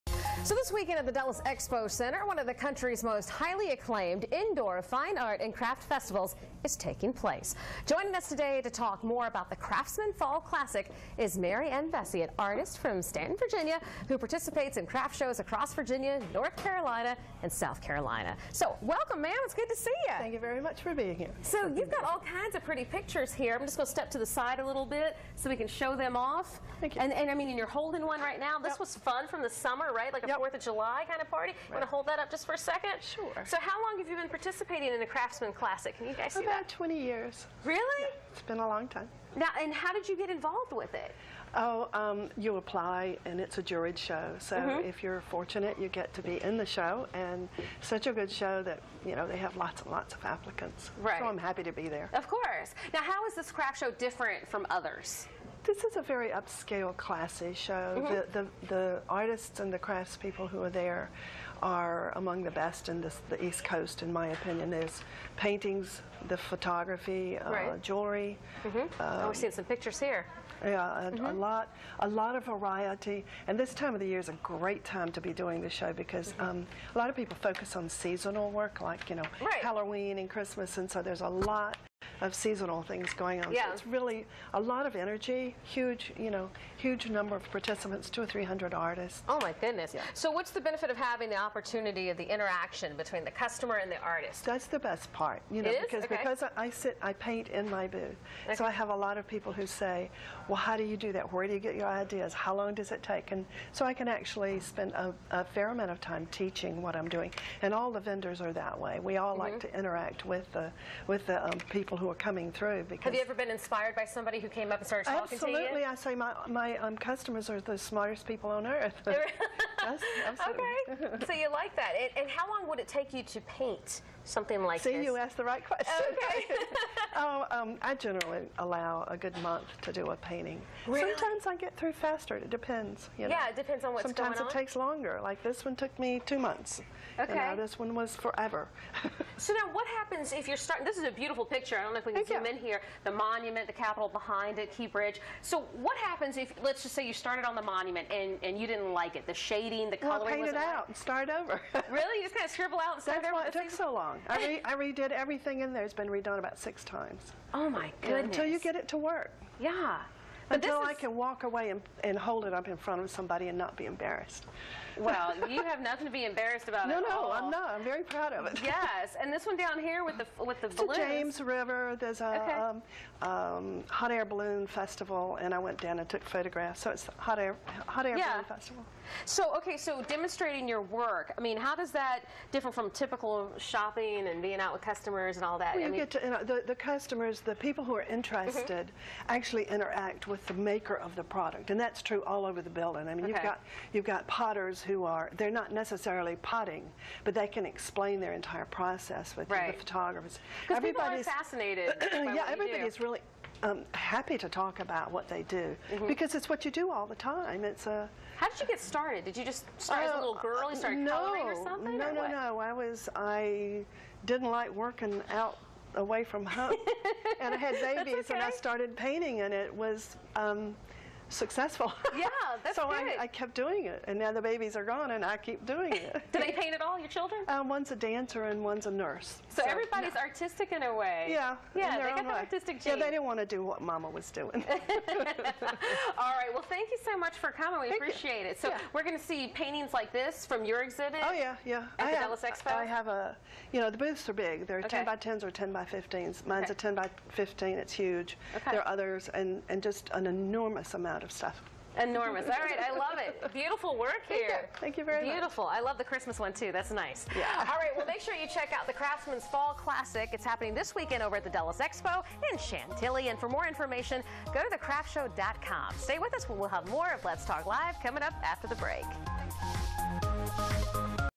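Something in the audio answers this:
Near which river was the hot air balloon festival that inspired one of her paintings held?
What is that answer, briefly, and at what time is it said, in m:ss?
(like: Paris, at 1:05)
James River, at 2:50.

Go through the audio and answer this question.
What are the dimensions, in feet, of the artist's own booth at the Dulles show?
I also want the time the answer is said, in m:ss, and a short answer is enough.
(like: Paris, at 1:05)
10 by 15, at 4:06.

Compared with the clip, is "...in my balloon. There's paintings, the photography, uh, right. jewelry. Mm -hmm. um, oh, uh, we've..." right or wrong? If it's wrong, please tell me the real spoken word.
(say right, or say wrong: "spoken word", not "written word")
wrong: "opinion", not "balloon".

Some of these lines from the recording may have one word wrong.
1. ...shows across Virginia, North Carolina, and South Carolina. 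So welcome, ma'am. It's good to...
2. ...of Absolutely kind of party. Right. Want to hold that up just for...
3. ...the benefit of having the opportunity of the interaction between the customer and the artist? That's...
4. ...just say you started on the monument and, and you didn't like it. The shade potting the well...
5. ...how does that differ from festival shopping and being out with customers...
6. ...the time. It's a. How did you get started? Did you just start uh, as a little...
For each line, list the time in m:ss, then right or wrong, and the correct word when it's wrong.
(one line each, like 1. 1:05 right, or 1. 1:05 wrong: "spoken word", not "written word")
1. 0:15 right
2. 0:30 wrong: "July", not "Absolutely"
3. 1:30 right
4. 2:26 wrong: "repeating", not "potting"
5. 3:01 wrong: "typical", not "festival"
6. 3:27 right.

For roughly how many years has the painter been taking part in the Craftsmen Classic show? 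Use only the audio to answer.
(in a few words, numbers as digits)
20 years.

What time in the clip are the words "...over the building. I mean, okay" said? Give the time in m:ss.
3:12.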